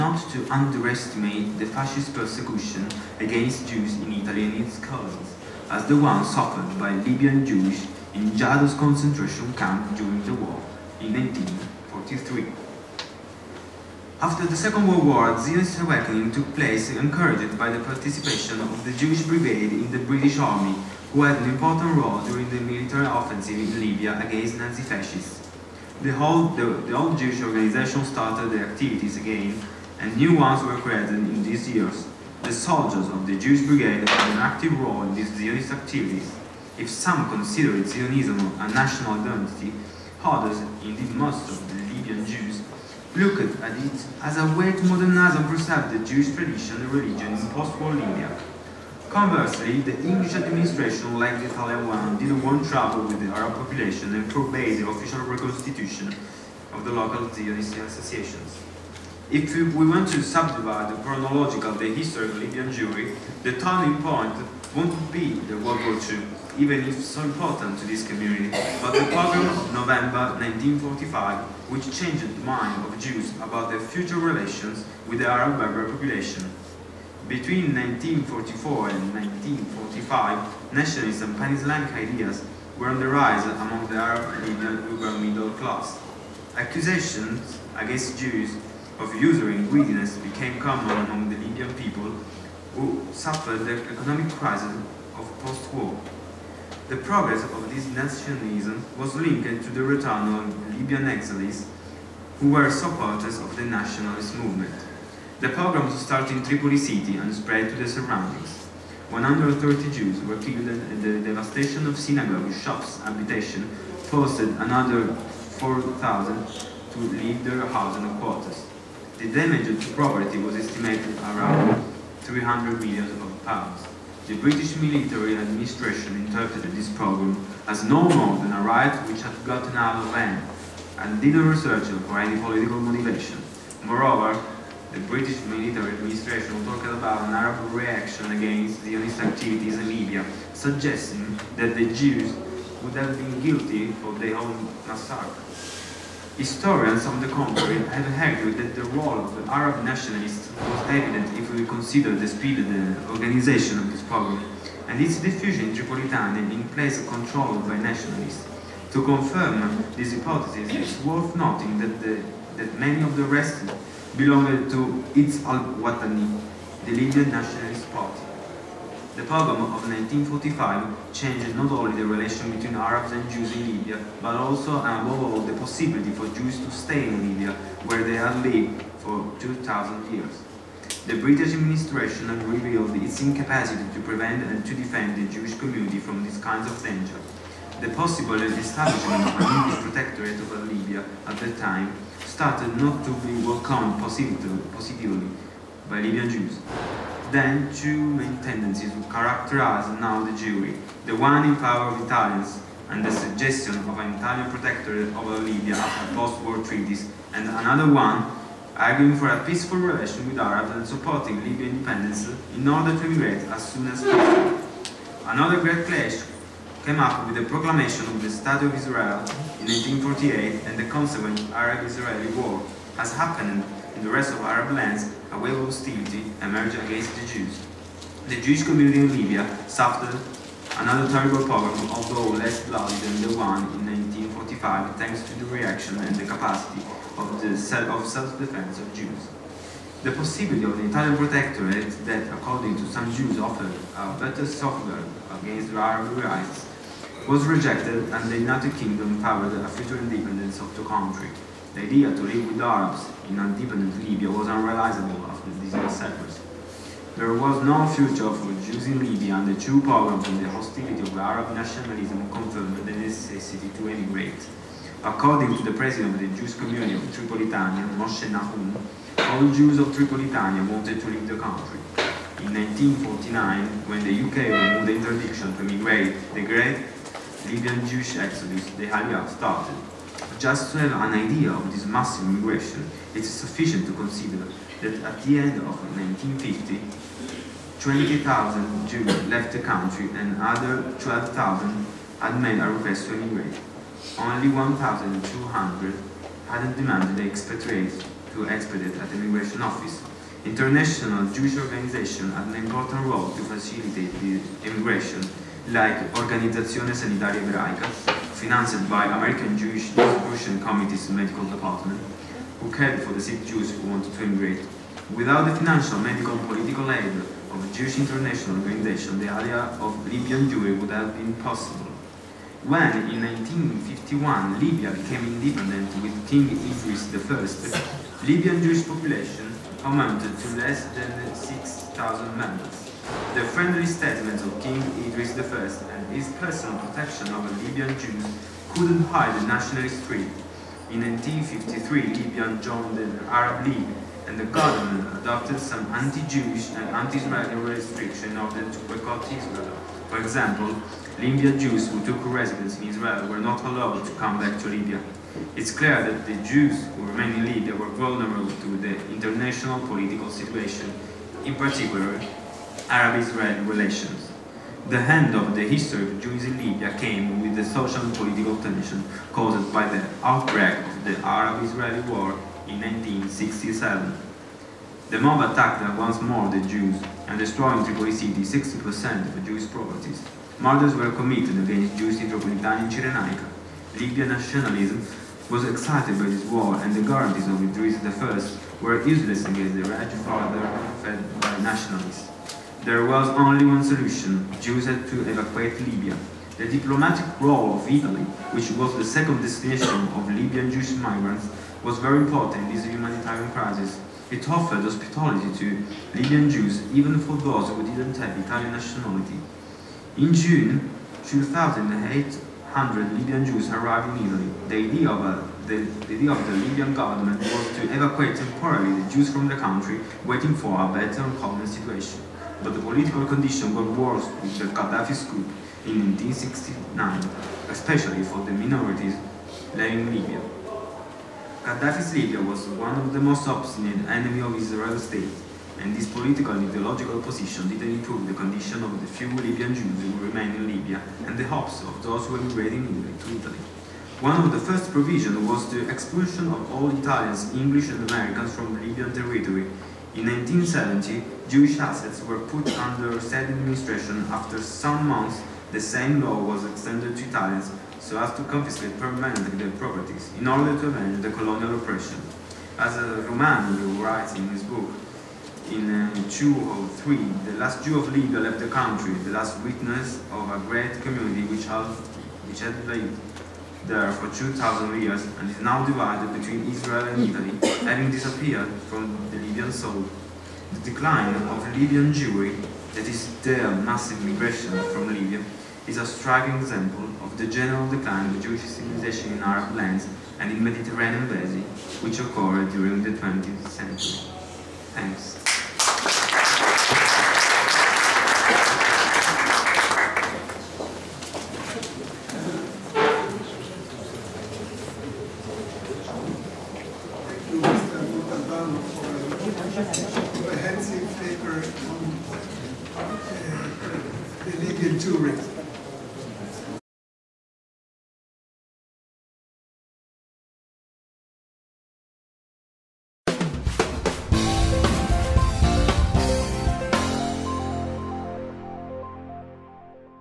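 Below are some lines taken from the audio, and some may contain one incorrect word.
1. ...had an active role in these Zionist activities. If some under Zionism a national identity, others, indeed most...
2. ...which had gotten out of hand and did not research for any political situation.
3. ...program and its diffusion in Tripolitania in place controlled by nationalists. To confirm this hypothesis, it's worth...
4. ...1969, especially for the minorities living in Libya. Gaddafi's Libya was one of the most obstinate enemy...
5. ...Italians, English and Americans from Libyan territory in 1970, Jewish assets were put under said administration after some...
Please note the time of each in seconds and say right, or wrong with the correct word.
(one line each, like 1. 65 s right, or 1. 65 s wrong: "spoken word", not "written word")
1. 34 s wrong: "consider", not "under"
2. 129 s wrong: "motivation", not "situation"
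3. 154 s right
4. 426 s right
5. 446 s right.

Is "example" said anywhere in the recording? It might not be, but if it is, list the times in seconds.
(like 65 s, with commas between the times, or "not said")
350 s, 486 s.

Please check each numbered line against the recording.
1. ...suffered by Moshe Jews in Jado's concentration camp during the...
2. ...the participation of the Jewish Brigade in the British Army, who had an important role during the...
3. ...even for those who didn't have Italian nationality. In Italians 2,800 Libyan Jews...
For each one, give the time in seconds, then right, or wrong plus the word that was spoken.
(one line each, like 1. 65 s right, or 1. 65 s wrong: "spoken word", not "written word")
1. 6 s wrong: "Libyan", not "Moshe"
2. 17 s right
3. 406 s wrong: "June", not "Italians".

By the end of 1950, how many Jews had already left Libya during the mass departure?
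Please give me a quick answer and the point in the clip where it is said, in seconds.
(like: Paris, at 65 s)
28,000, at 287 s.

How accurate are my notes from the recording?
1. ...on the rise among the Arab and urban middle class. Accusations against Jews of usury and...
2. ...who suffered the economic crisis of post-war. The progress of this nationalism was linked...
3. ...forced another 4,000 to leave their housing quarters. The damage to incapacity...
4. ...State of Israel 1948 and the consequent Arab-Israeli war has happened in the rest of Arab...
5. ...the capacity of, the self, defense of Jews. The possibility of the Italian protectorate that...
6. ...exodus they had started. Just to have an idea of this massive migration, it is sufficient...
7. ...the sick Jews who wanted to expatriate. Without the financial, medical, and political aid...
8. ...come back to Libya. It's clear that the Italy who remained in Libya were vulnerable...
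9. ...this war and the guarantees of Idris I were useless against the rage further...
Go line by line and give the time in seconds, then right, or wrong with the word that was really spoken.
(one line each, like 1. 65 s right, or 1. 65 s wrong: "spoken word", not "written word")
1. 82 s right
2. 92 s right
3. 114 s wrong: "property", not "incapacity"
4. 218 s right
5. 236 s right
6. 278 s right
7. 313 s wrong: "immigrate", not "expatriate"
8. 354 s wrong: "Jews", not "Italy"
9. 386 s right.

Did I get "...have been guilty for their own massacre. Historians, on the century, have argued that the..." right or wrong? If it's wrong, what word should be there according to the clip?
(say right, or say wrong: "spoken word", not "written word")
wrong: "contrary", not "century".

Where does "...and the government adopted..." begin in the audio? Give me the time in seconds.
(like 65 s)
344 s.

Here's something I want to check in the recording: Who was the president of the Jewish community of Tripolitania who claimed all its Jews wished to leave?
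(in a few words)
Moshe Nahum.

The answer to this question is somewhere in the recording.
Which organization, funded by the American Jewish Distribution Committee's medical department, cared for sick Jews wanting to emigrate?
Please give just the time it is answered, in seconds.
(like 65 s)
306 s.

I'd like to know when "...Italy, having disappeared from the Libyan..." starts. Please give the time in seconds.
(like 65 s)
477 s.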